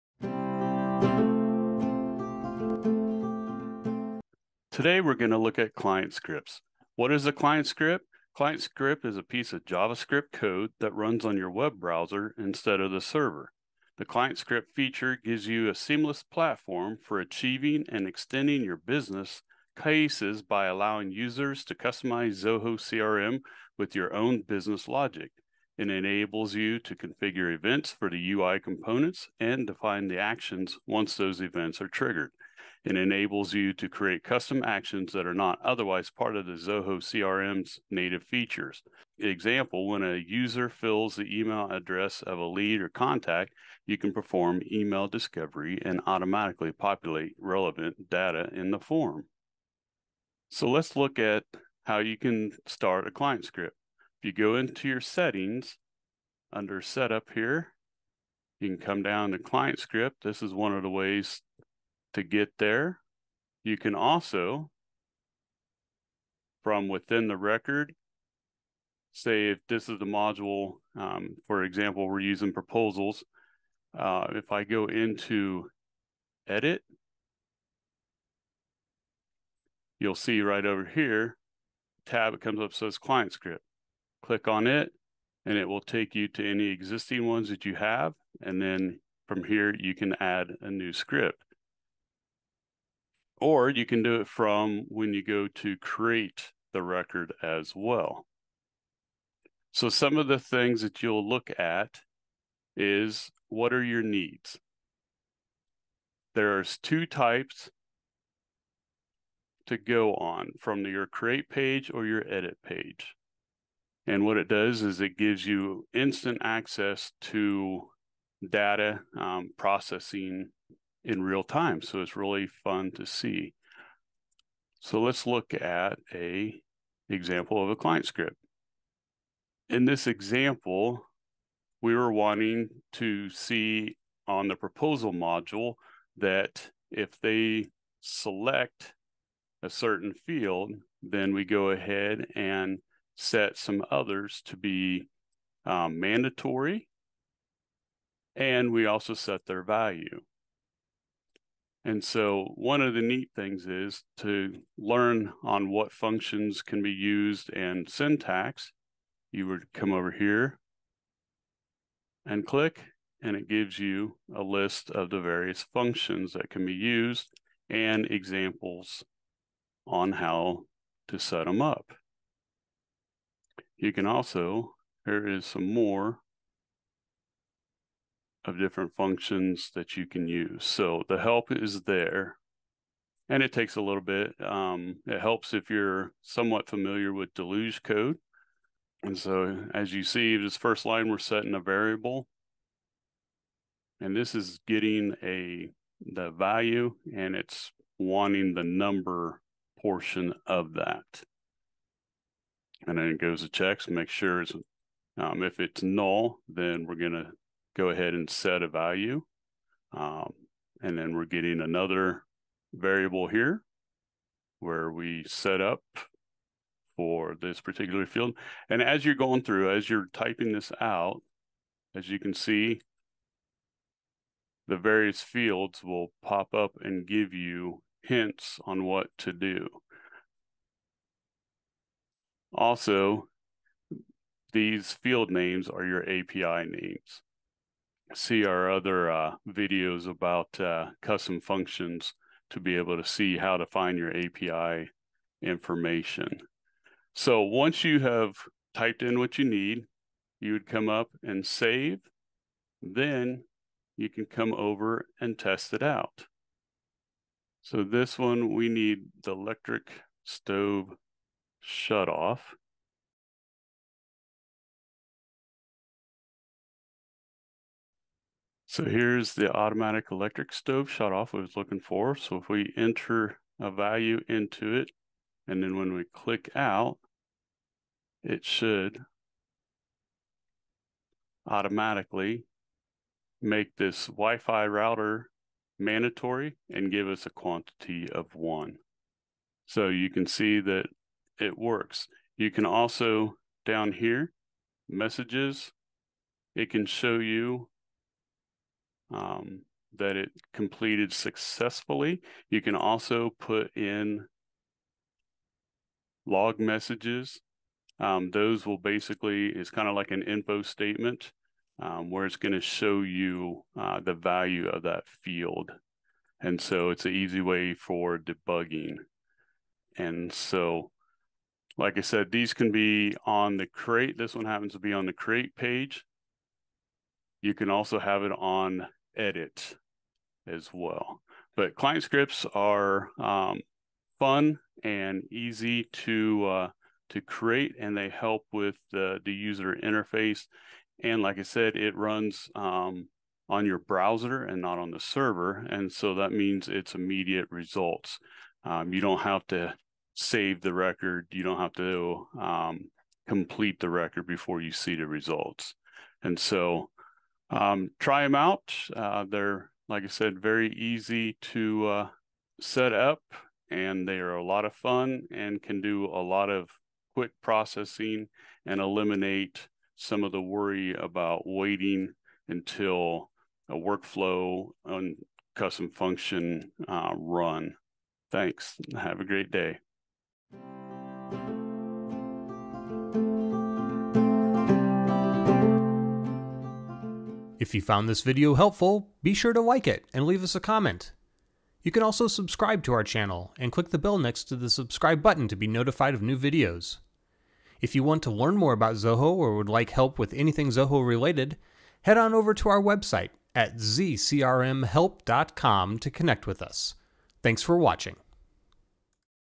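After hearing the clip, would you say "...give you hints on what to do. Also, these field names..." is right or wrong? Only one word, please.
right.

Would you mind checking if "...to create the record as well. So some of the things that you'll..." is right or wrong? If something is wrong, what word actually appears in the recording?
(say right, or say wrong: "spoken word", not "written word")
right.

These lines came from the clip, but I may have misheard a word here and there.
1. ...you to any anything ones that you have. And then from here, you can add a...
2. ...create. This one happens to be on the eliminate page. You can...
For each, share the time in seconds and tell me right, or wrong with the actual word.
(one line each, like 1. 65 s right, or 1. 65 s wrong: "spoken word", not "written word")
1. 86 s wrong: "existing", not "anything"
2. 323 s wrong: "create", not "eliminate".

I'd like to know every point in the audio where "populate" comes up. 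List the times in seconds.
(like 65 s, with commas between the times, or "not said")
46 s.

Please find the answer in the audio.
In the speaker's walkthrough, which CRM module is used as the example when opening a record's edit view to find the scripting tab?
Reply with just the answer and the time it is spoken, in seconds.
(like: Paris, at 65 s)
Proposals, at 72 s.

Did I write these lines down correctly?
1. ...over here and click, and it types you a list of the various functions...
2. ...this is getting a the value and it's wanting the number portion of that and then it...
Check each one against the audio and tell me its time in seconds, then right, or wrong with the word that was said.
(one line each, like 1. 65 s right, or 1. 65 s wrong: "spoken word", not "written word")
1. 159 s wrong: "gives", not "types"
2. 194 s right.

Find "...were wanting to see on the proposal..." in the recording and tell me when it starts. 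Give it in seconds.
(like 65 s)
131 s.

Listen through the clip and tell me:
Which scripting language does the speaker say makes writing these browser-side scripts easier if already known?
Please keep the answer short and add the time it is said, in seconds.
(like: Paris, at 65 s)
Deluge, at 187 s.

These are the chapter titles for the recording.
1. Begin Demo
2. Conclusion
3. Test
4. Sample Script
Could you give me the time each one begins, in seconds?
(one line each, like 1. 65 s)
1. 50 s
2. 330 s
3. 256 s
4. 129 s.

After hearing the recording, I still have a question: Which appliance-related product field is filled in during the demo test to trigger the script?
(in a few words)
Automatic electric stove shut off.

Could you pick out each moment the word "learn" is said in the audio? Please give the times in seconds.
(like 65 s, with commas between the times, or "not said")
154 s, 398 s.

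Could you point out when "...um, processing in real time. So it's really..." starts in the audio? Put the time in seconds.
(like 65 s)
119 s.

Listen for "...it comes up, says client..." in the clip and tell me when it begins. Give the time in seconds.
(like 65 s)
82 s.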